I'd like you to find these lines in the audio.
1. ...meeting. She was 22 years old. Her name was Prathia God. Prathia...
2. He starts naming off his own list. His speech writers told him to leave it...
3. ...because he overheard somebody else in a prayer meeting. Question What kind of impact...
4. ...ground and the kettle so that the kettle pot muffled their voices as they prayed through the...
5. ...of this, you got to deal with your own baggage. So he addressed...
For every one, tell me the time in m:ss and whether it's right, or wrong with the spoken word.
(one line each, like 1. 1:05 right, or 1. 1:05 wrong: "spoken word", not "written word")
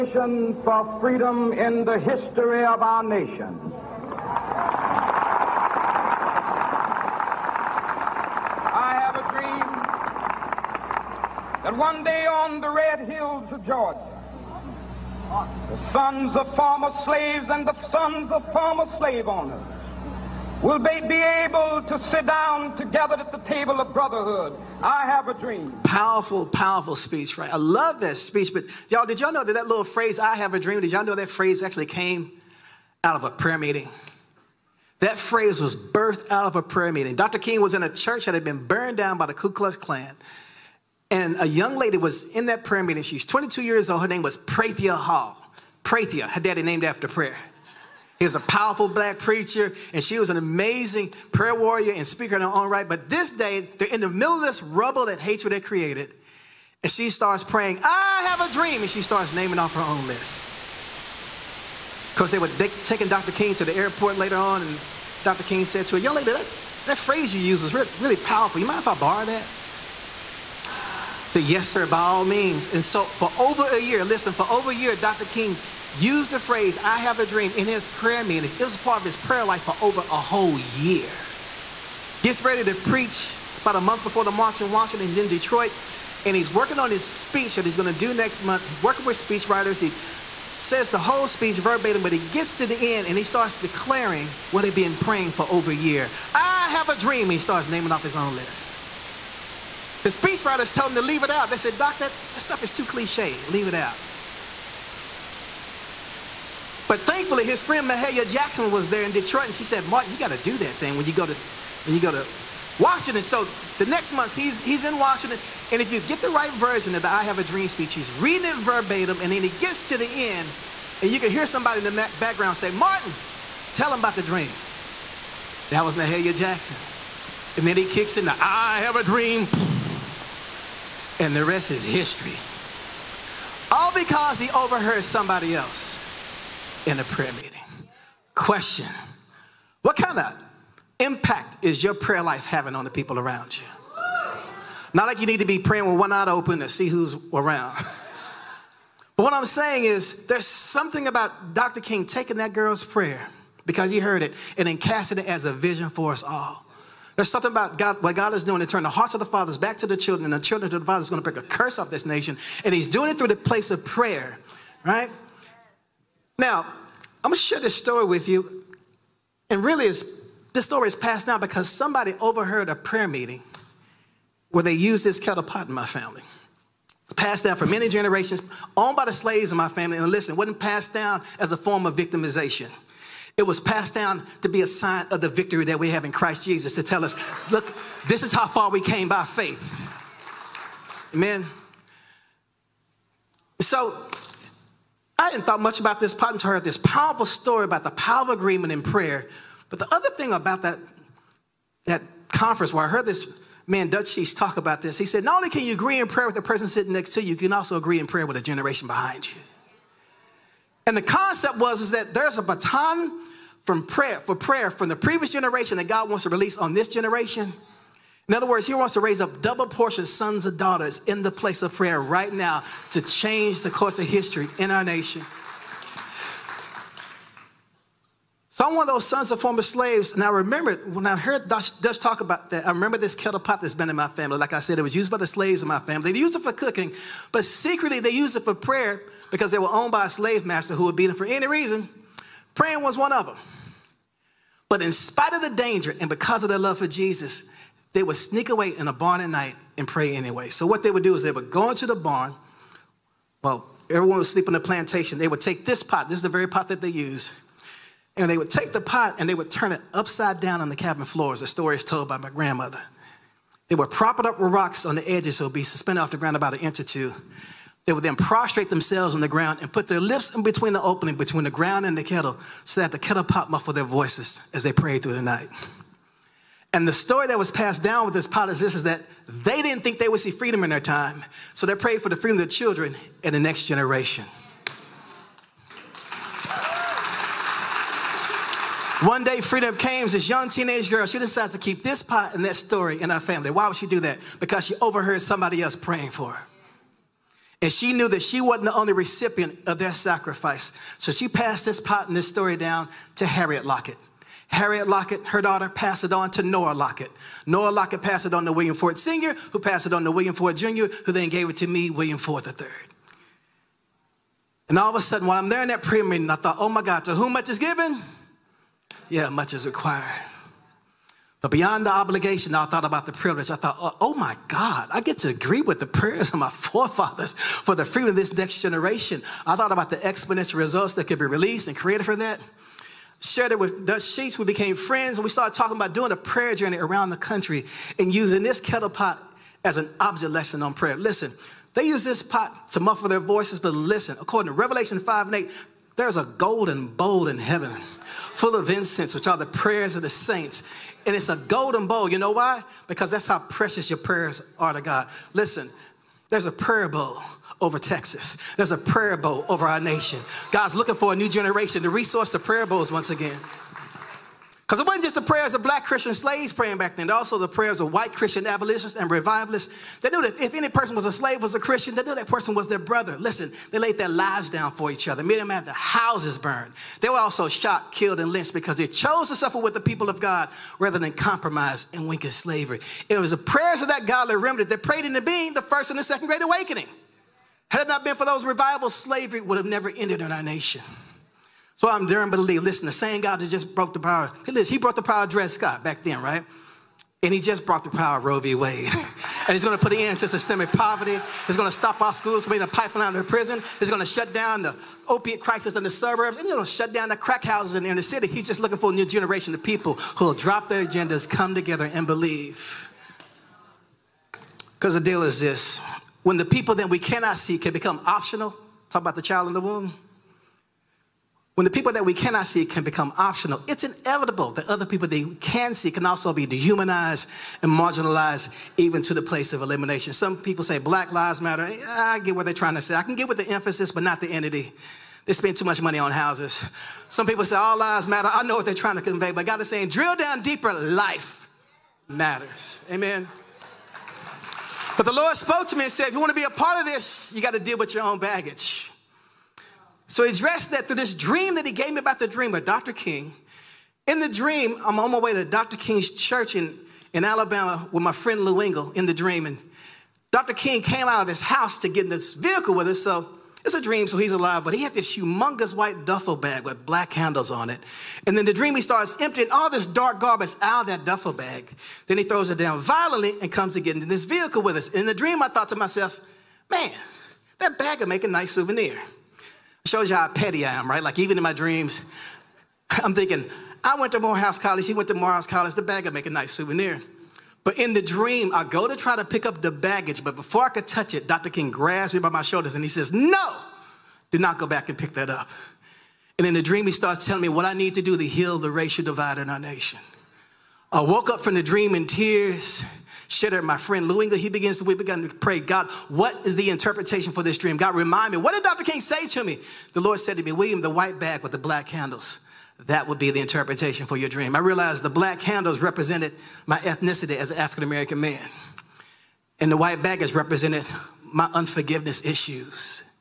1. 0:42 wrong: "Hall", not "God"
2. 1:37 right
3. 2:13 right
4. 4:31 right
5. 7:26 right.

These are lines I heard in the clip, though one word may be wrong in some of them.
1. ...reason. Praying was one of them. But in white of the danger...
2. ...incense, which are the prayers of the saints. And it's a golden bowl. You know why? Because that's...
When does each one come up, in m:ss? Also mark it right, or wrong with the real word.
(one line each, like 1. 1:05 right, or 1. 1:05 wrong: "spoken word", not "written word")
1. 4:01 wrong: "spite", not "white"
2. 5:48 right.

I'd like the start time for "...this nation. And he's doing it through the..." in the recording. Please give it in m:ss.
2:41.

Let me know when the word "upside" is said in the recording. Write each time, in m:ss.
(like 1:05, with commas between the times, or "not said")
4:19.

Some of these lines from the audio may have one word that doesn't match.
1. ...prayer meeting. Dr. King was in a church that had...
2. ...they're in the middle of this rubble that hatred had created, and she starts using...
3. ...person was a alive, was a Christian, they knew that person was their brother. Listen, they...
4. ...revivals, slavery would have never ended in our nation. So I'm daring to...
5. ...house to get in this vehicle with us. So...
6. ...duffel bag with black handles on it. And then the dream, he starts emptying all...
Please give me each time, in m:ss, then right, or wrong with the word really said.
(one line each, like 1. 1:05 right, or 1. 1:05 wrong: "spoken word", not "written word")
1. 0:36 right
2. 0:53 wrong: "praying", not "using"
3. 6:10 wrong: "slave", not "alive"
4. 6:28 right
5. 7:41 right
6. 7:46 right.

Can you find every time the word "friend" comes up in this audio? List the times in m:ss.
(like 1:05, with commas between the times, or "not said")
1:47, 5:34, 7:38, 8:23.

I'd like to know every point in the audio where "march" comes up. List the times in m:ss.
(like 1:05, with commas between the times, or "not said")
1:24.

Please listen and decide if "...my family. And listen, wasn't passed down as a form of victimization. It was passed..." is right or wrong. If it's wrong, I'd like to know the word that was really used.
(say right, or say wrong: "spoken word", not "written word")
right.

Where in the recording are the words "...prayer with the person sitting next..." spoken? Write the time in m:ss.
3:26.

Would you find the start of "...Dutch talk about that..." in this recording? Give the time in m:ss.
3:51.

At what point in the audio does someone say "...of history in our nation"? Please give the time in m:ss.
3:43.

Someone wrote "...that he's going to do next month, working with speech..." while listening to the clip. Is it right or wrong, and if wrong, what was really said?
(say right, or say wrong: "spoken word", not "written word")
right.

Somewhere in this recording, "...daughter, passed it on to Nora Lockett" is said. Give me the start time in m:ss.
5:05.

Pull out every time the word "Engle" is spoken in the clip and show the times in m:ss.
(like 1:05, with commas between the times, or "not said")
7:38, 8:24.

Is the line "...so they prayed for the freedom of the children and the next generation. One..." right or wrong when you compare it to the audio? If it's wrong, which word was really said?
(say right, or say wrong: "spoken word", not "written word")
right.